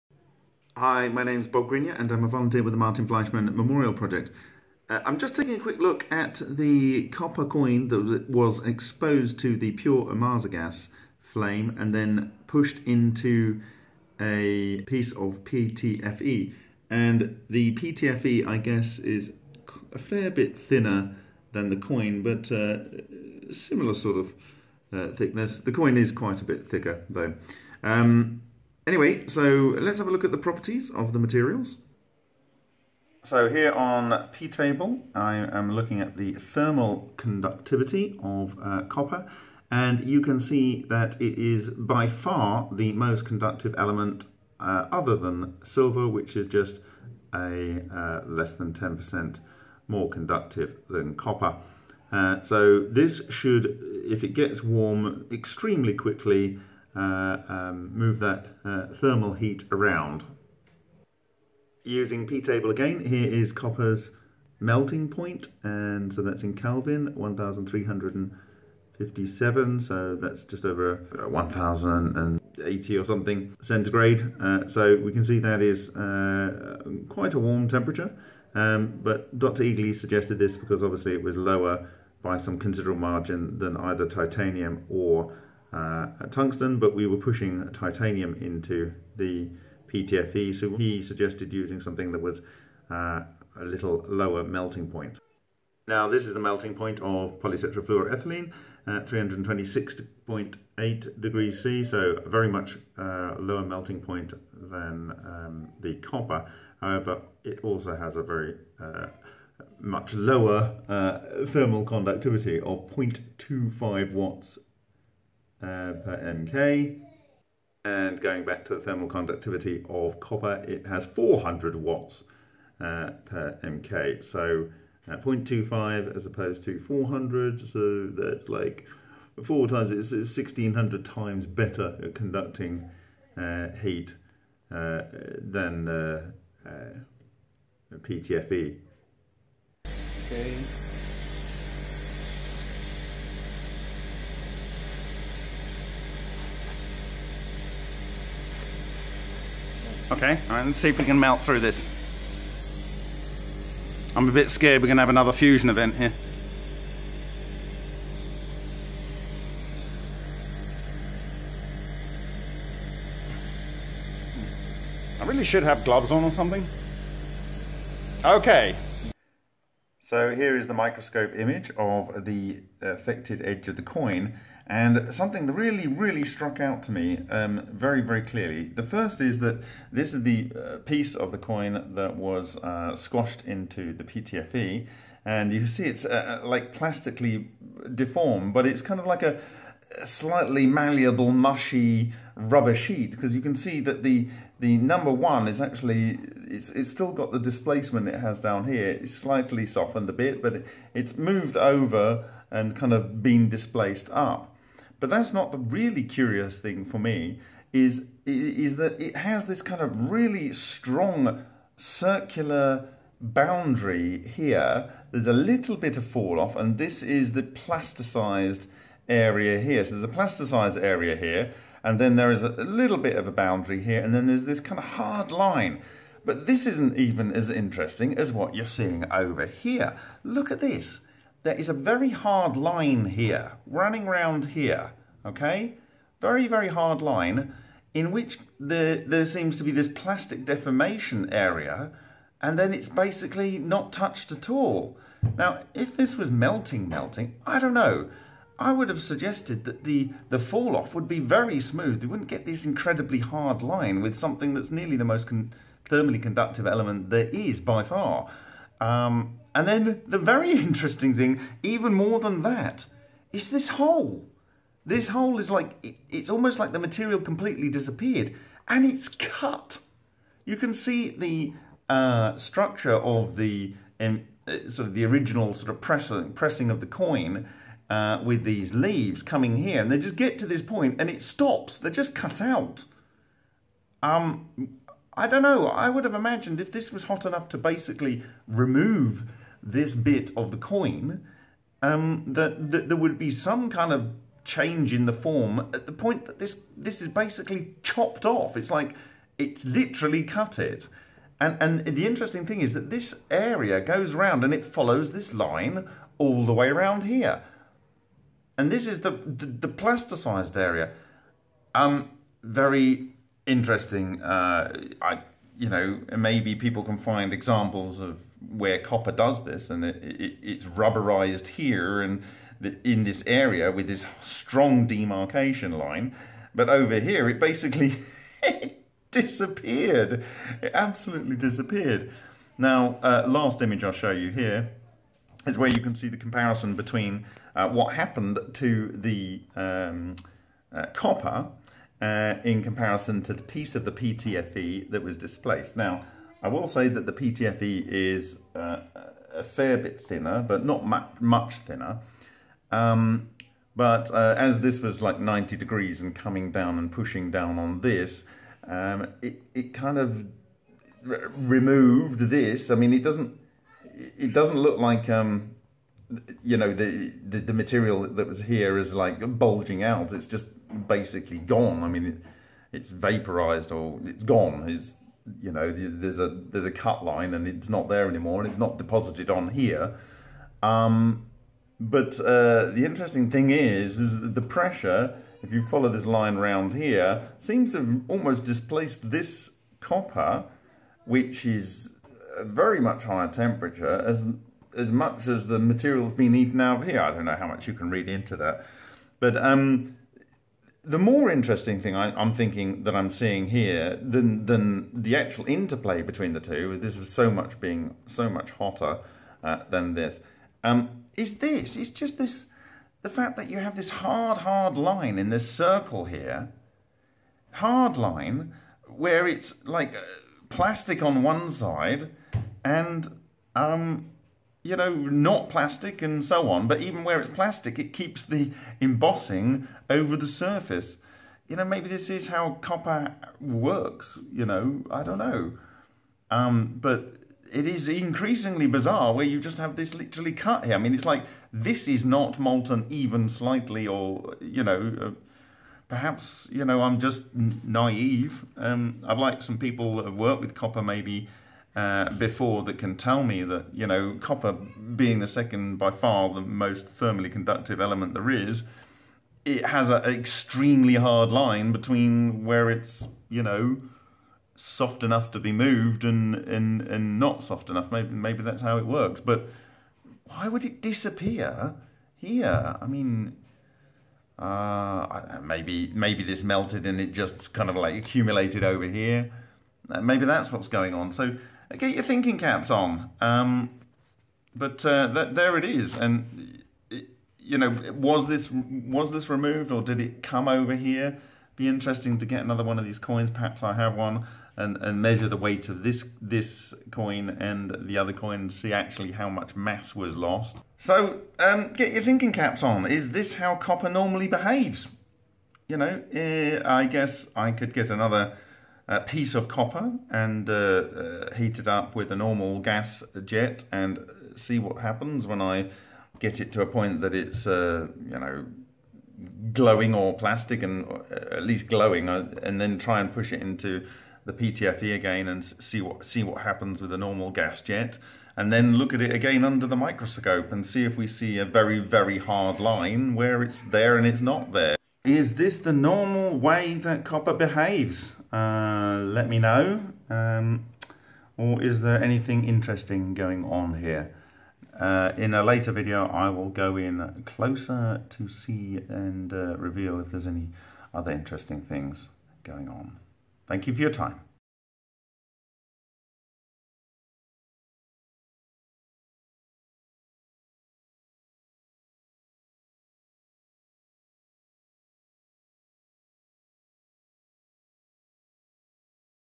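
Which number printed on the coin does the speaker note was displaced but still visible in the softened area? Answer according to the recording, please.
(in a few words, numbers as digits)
1.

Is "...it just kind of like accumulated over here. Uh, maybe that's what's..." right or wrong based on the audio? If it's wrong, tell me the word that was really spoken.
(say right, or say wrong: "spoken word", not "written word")
right.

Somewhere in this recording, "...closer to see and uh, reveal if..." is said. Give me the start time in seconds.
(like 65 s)
547 s.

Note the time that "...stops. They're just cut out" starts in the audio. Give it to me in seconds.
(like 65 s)
281 s.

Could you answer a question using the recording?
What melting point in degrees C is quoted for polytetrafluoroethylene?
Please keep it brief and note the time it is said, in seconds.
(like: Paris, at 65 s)
326.8, at 99 s.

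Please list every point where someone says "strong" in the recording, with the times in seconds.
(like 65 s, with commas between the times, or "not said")
210 s, 324 s.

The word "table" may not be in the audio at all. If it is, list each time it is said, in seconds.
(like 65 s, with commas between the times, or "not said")
34 s, 62 s.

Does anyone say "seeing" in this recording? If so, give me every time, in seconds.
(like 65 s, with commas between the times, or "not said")
228 s, 403 s.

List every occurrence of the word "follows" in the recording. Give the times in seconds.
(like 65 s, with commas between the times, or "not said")
304 s, 385 s.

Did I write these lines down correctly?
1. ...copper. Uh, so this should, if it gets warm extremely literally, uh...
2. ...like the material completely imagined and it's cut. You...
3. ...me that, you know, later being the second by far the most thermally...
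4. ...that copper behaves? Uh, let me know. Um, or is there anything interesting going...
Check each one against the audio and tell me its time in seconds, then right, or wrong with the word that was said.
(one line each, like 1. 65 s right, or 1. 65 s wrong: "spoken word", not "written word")
1. 51 s wrong: "quickly", not "literally"
2. 266 s wrong: "disappeared", not "imagined"
3. 453 s wrong: "copper", not "later"
4. 536 s right.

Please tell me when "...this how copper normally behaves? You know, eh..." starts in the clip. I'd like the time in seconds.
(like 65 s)
503 s.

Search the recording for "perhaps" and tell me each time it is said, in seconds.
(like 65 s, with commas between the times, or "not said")
445 s, 493 s.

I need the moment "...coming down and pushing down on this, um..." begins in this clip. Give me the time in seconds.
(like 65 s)
356 s.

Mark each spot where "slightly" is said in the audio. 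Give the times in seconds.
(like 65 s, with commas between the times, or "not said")
190 s, 199 s, 443 s.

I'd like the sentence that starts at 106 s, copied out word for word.
However, it also has a very uh, much lower uh, thermal conductivity of 0.25 watts uh, per mk.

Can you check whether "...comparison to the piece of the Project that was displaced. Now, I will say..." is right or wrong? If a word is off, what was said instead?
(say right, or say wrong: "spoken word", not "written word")
wrong: "PTFE", not "Project".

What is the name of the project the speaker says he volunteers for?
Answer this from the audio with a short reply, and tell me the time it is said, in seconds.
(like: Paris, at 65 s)
Martin Fleischmann Memorial Project, at 2 s.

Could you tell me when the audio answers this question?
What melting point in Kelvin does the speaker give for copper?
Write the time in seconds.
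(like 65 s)
67 s.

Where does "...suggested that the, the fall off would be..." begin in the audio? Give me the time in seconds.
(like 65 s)
249 s.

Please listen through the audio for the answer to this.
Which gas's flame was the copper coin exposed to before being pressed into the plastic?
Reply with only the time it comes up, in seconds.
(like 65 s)
10 s.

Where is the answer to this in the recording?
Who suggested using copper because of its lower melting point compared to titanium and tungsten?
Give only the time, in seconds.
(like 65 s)
79 s.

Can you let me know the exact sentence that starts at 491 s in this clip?
Be interesting to get another one of these coins.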